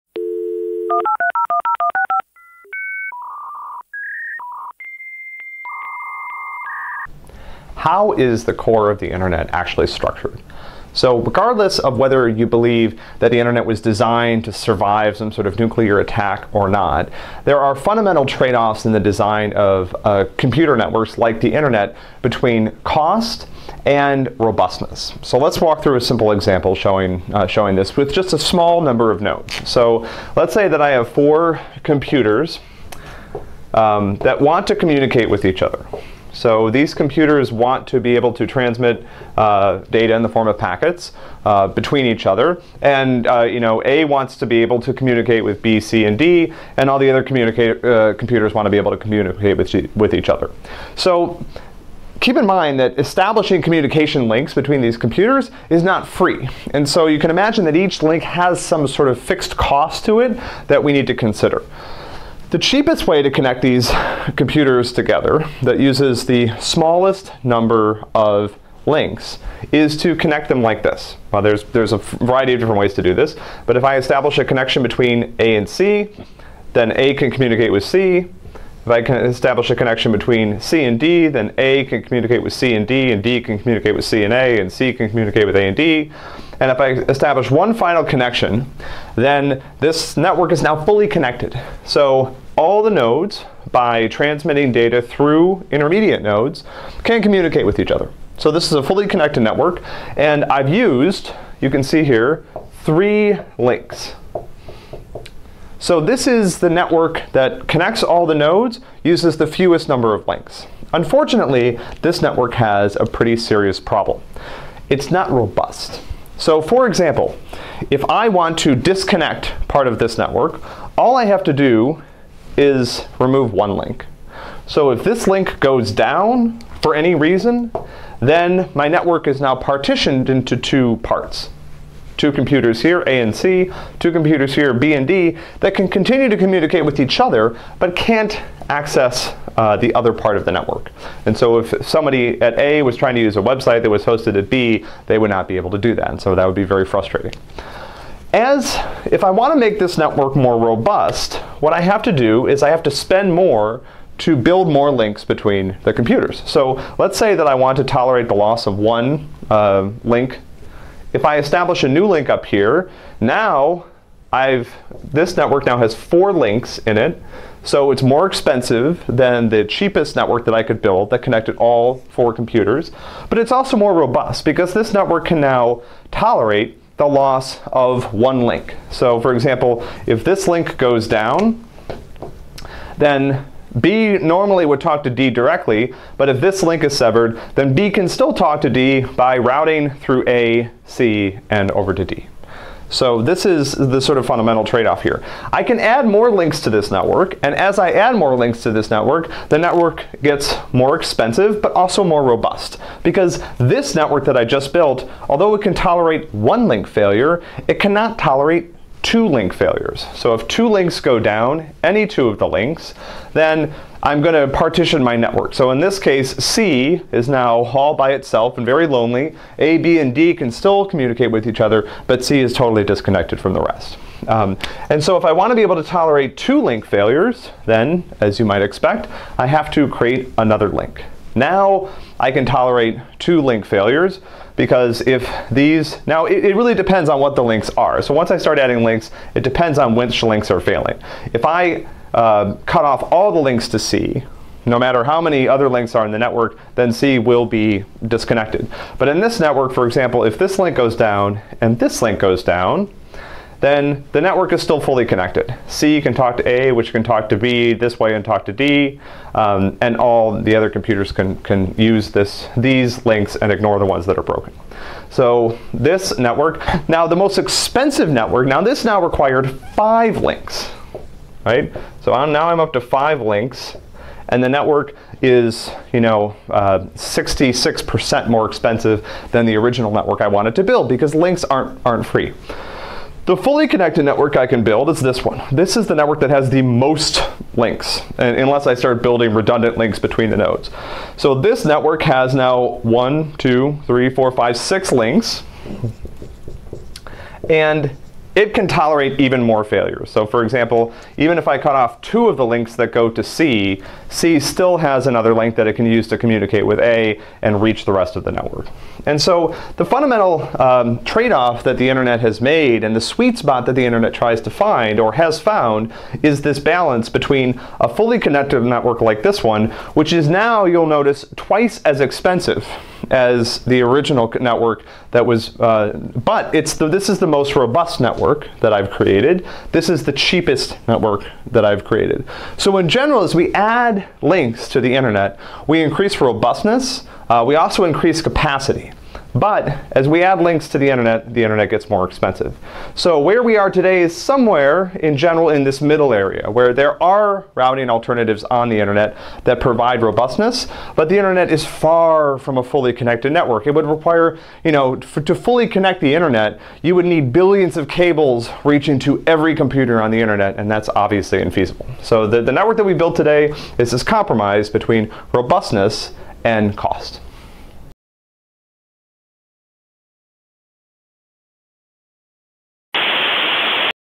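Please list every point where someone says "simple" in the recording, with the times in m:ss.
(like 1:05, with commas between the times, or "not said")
0:26.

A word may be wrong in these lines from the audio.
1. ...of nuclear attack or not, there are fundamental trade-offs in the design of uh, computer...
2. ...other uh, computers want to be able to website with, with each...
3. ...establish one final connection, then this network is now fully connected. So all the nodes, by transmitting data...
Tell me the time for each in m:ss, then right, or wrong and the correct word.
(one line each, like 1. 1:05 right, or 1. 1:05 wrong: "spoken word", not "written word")
1. 0:15 right
2. 0:47 wrong: "communicate", not "website"
3. 1:27 right.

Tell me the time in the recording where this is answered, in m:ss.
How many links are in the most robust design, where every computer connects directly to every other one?
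4:54.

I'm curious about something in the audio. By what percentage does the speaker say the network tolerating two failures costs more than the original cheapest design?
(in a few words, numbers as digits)
66%.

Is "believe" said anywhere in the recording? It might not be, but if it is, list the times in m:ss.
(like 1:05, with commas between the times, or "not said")
0:12.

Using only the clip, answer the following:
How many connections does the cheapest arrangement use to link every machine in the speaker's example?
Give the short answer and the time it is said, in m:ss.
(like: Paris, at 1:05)
3, at 1:42.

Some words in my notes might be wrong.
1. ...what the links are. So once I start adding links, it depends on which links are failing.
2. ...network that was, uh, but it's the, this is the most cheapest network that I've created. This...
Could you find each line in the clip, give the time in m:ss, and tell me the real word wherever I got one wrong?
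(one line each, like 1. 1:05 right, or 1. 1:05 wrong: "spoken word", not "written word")
1. 3:57 right
2. 5:24 wrong: "robust", not "cheapest".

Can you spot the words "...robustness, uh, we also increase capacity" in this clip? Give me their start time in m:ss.
5:36.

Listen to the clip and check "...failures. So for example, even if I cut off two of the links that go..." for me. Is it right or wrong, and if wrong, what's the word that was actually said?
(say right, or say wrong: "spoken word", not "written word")
right.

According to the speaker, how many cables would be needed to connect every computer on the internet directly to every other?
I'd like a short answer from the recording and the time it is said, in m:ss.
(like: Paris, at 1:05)
billions, at 5:57.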